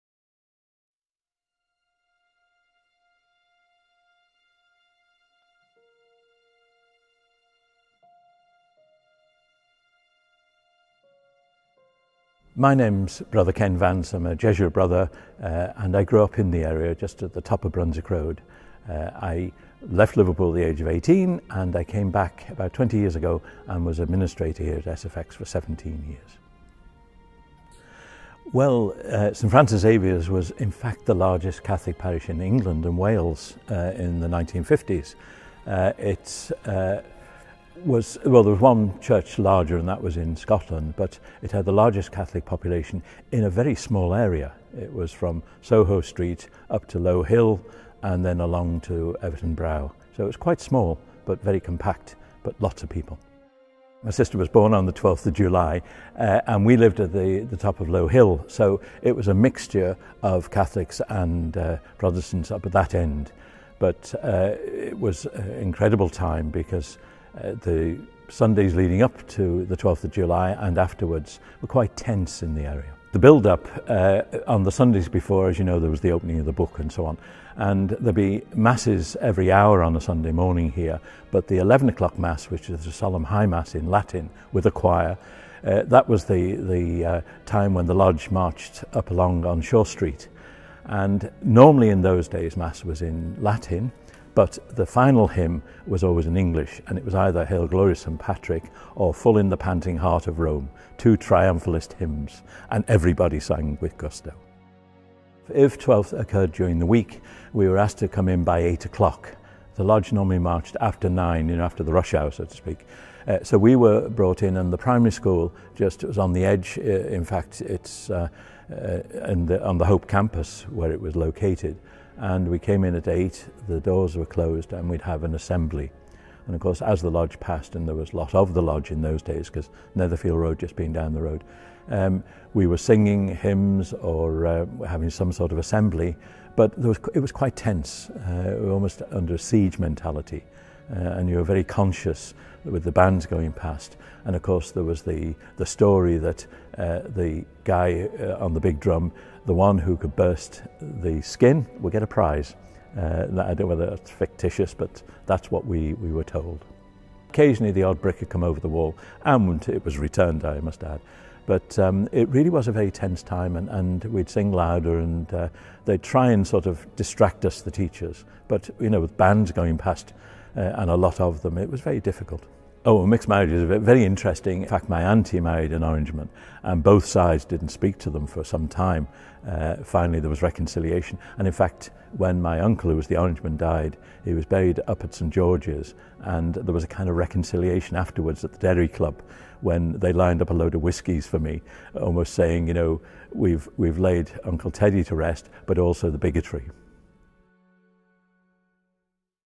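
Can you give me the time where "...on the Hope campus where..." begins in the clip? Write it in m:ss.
1:59.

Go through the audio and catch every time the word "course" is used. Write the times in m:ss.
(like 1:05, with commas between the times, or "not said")
2:06, 2:24.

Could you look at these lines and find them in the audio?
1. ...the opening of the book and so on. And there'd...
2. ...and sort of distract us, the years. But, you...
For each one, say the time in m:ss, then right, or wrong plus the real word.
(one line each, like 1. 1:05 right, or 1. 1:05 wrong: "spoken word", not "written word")
1. 1:15 right
2. 2:46 wrong: "teachers", not "years".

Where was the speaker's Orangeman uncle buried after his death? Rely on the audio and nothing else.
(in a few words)
St George's.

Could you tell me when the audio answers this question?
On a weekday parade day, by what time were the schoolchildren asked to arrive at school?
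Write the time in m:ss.
1:48.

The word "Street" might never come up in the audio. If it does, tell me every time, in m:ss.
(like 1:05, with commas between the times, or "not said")
0:46, 1:29.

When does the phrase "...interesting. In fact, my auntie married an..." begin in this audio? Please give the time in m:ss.
2:54.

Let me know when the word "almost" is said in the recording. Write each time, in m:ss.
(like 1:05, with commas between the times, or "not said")
2:18, 3:12.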